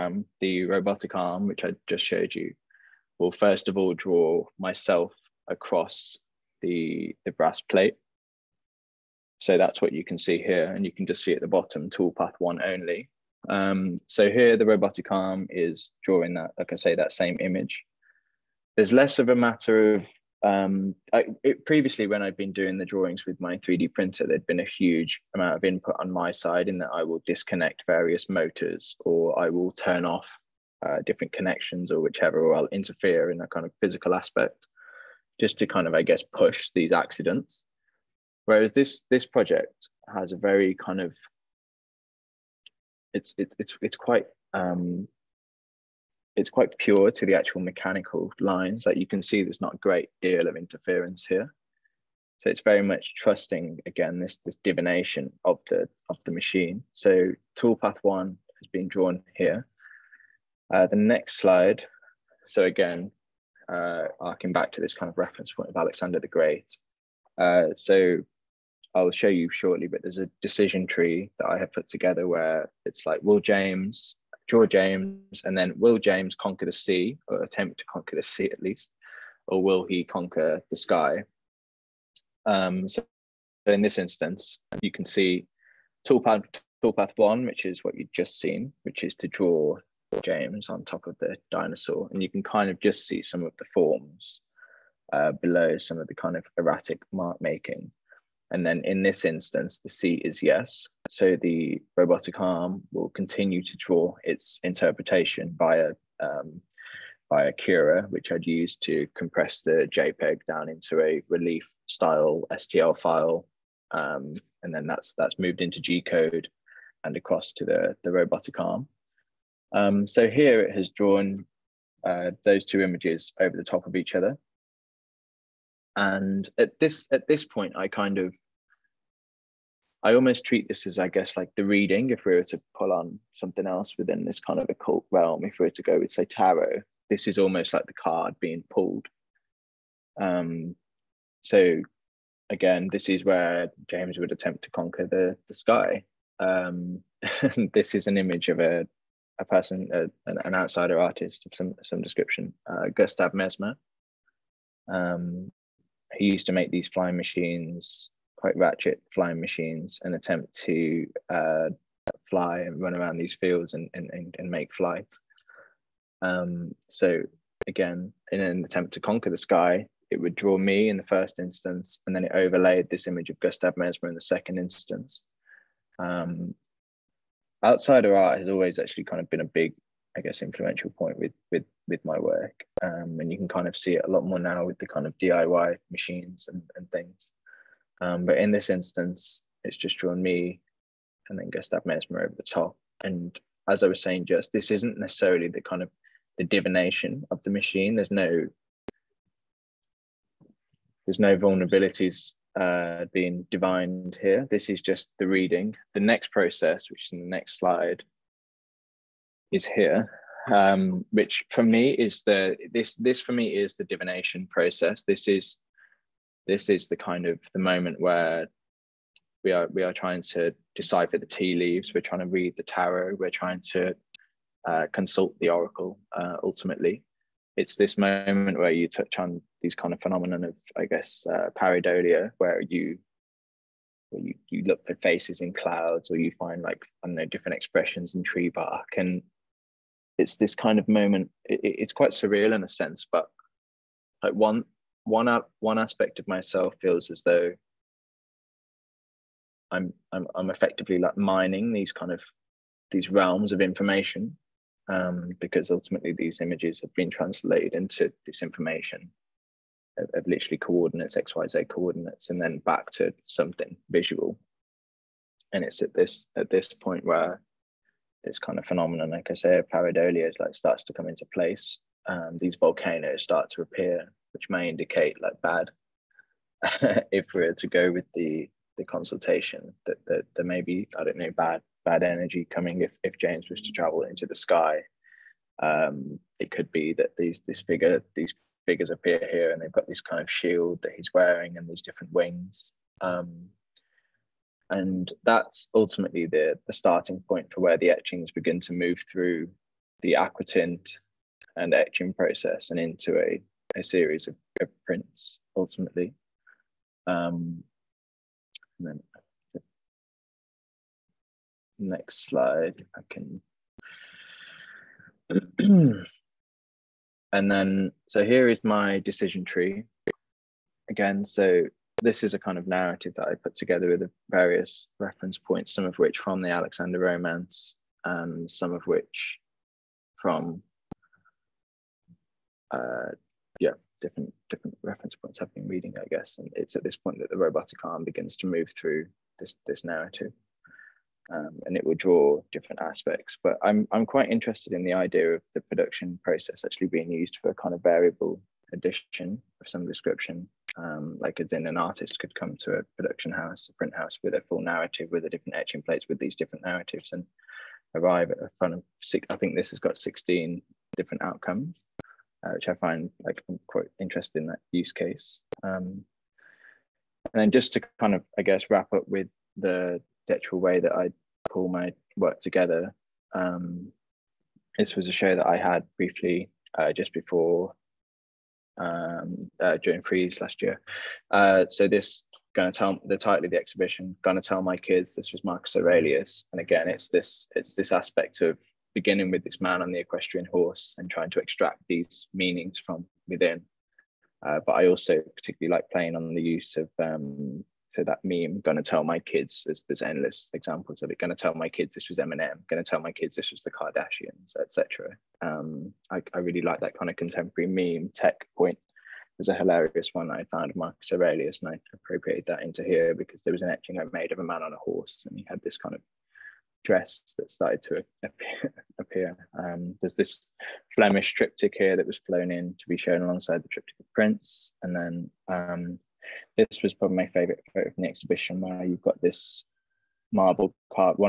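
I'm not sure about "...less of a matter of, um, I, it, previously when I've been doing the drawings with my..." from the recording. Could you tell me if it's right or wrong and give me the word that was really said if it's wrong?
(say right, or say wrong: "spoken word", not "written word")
right.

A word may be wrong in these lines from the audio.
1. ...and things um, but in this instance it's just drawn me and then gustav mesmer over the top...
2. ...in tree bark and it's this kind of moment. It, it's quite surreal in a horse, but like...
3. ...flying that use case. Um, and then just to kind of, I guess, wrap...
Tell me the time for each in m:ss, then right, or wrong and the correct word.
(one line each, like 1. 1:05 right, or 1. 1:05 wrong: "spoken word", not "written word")
1. 3:06 right
2. 3:58 wrong: "sense", not "horse"
3. 6:03 wrong: "interesting", not "flying".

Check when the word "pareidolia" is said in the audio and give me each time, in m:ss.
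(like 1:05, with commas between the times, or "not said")
3:51, 4:29.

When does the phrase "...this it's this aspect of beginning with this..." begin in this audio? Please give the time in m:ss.
6:27.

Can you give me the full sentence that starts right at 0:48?
Like you can see there's not a great deal of interference here.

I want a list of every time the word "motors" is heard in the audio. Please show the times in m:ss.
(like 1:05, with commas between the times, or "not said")
0:28.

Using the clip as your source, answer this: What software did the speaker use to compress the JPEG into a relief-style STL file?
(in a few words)
Cura.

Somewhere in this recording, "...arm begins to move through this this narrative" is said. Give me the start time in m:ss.
5:37.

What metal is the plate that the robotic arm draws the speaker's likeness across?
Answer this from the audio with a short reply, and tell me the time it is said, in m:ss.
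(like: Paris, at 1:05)
Brass, at 0:07.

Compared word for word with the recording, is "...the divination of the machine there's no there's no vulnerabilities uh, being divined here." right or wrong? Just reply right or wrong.
right.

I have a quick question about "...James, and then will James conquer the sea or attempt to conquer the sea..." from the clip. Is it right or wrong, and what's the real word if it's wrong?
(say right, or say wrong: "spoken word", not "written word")
right.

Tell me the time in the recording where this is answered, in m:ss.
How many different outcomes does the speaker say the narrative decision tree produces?
5:59.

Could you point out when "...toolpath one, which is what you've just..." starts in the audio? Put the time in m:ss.
1:26.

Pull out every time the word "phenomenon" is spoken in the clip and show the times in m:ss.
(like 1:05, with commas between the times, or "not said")
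3:50, 4:28.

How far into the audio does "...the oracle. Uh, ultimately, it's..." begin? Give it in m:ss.
3:45.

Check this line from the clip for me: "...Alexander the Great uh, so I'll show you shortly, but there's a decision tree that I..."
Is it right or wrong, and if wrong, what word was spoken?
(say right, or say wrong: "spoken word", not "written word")
right.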